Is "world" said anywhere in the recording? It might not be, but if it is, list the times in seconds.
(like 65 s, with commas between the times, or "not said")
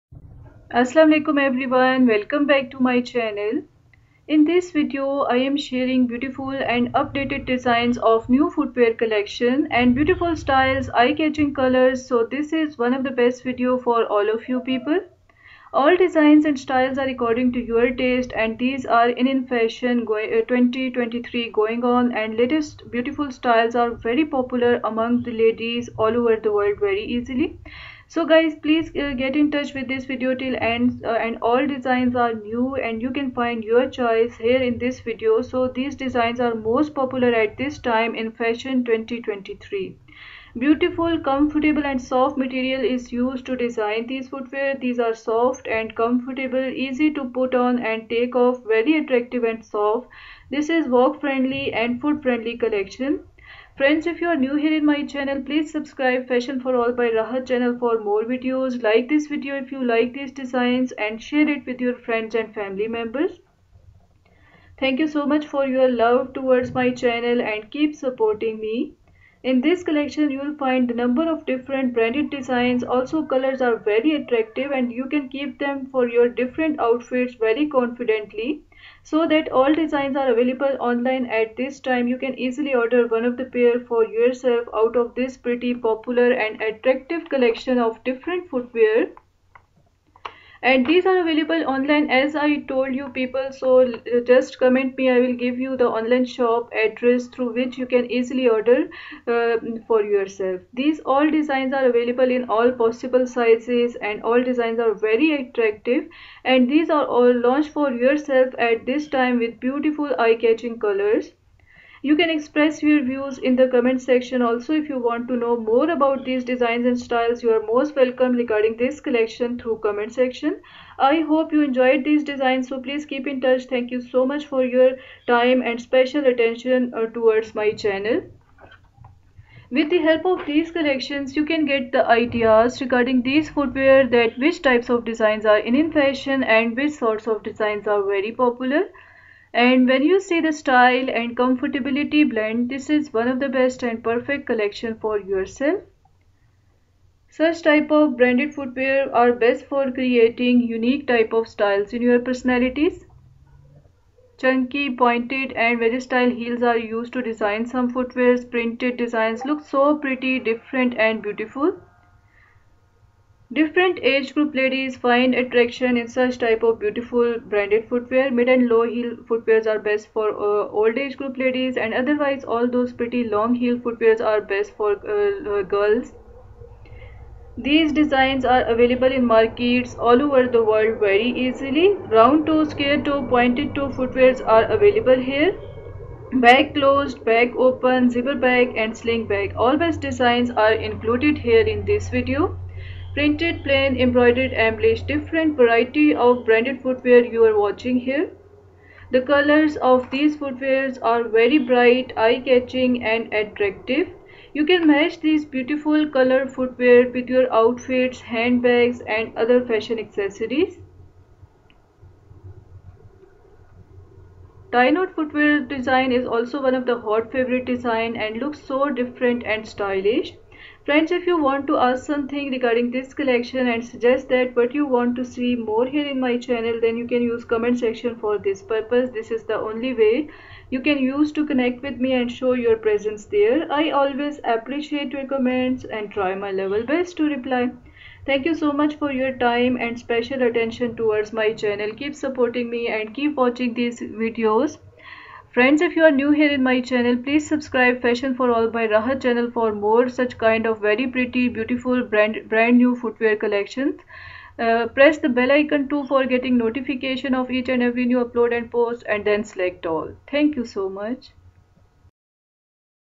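26 s, 180 s.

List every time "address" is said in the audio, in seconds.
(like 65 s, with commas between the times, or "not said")
96 s.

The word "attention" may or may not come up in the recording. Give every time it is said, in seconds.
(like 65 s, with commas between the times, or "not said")
126 s, 240 s.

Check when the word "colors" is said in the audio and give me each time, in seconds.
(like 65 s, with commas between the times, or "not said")
11 s, 73 s, 110 s, 199 s, 206 s.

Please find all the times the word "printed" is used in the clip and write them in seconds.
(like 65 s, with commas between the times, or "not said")
158 s, 193 s.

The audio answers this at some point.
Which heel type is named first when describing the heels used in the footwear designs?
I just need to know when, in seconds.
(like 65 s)
154 s.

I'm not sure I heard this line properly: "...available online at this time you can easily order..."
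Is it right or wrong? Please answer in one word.
right.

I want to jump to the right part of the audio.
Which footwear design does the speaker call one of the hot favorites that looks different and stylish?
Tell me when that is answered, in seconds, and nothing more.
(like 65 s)
214 s.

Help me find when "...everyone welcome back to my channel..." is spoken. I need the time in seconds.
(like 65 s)
1 s.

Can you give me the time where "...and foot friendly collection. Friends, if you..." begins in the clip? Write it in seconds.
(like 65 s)
51 s.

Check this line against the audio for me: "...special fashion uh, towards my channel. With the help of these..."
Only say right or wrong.
wrong.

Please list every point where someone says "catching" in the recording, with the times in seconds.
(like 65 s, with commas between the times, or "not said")
11 s, 110 s, 202 s.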